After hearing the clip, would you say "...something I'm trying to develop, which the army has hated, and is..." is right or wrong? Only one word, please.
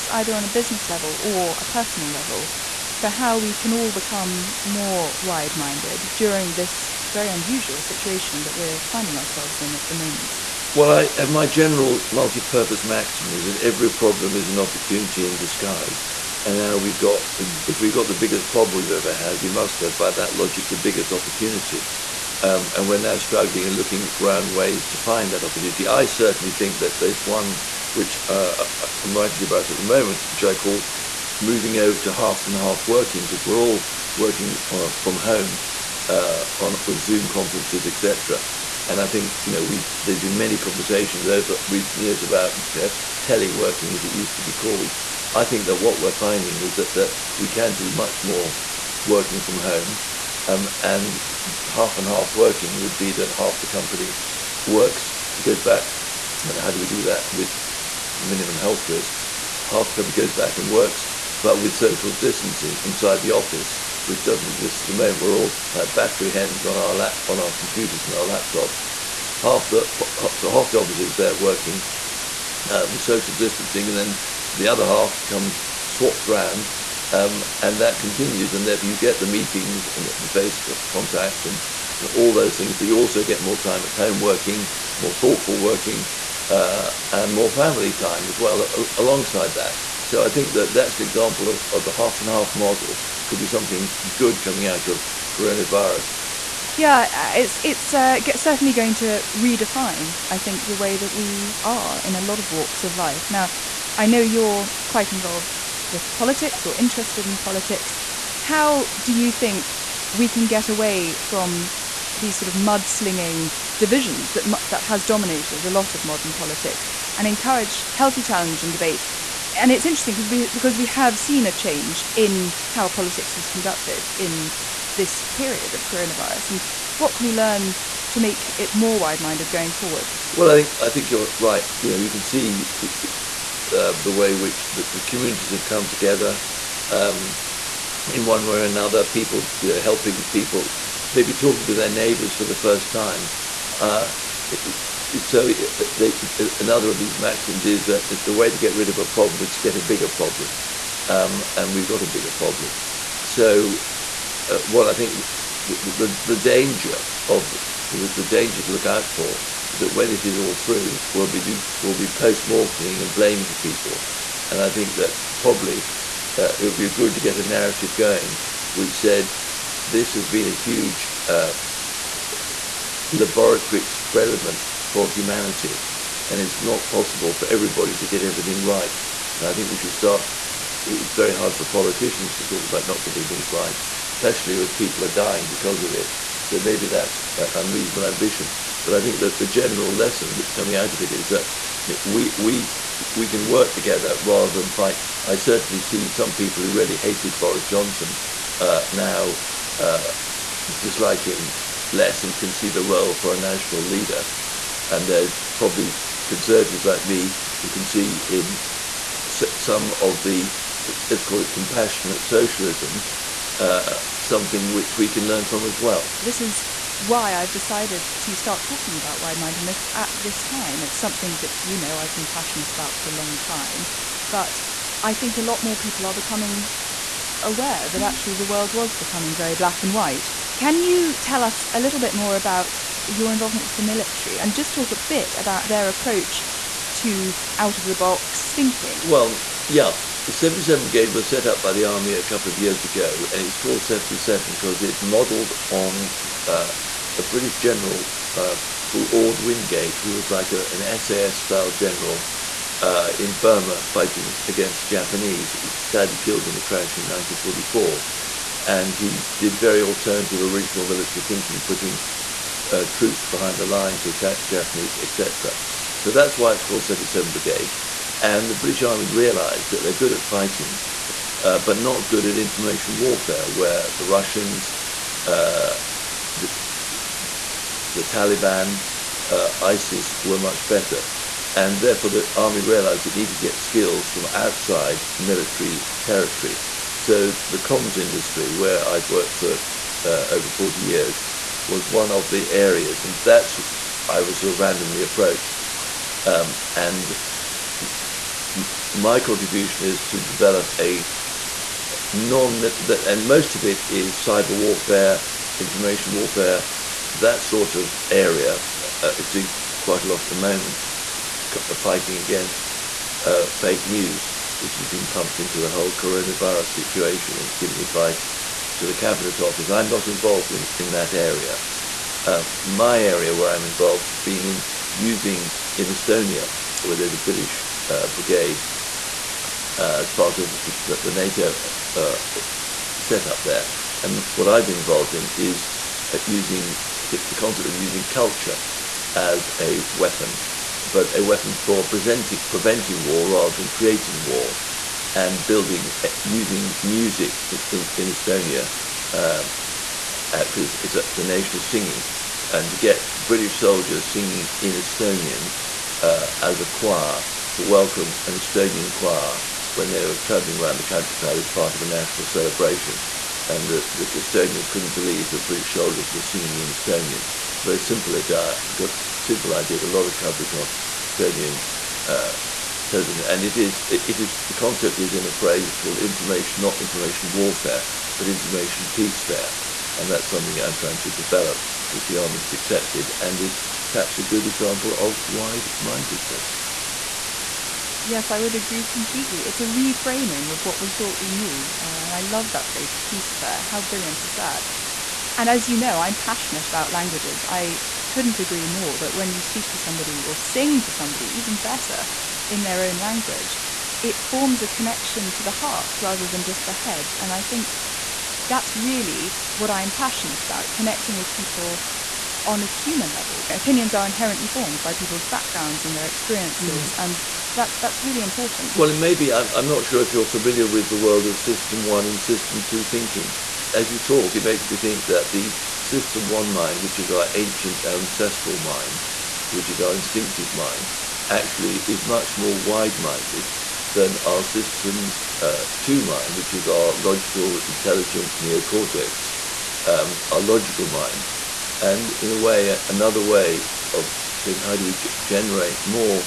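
wrong.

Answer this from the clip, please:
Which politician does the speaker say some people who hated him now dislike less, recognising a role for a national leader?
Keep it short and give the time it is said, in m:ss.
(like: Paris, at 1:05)
Boris Johnson, at 3:17.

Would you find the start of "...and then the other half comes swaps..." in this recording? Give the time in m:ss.
1:13.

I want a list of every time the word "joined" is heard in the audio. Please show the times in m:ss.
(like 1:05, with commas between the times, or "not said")
not said.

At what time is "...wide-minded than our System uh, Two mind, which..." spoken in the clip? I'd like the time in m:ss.
7:12.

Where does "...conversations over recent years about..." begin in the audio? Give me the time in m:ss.
0:40.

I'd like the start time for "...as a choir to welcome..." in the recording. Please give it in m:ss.
5:56.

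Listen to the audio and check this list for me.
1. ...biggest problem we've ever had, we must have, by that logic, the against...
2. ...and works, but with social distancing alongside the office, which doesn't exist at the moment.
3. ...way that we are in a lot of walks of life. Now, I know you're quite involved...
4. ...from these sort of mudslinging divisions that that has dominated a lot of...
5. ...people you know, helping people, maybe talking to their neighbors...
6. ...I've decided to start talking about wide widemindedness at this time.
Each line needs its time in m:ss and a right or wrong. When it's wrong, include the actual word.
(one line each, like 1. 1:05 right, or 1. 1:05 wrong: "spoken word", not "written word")
1. 0:18 wrong: "biggest", not "against"
2. 1:00 wrong: "inside", not "alongside"
3. 1:40 right
4. 1:51 right
5. 2:19 right
6. 3:37 wrong: "mindedness", not "widemindedness".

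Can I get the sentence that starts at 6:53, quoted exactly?
Opinions are inherently formed by people's backgrounds and their experiences, mm.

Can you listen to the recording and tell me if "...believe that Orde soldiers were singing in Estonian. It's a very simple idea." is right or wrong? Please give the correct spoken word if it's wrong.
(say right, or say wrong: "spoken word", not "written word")
wrong: "British", not "Orde".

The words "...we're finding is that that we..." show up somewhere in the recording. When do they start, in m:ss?
0:46.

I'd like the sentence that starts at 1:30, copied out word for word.
So I think that that's an example of, of, the half and half model could be something good coming out of coronavirus.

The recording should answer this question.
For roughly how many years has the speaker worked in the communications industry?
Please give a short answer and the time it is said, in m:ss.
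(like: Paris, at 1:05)
over 40 years, at 4:50.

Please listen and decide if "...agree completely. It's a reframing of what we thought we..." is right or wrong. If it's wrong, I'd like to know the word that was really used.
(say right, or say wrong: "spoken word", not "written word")
right.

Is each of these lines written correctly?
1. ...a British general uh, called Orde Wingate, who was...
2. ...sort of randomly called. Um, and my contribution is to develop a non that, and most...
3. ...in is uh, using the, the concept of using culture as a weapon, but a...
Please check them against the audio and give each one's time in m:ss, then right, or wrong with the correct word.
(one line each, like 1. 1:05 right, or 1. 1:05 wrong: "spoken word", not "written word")
1. 4:07 right
2. 4:54 wrong: "approached", not "called"
3. 5:35 right.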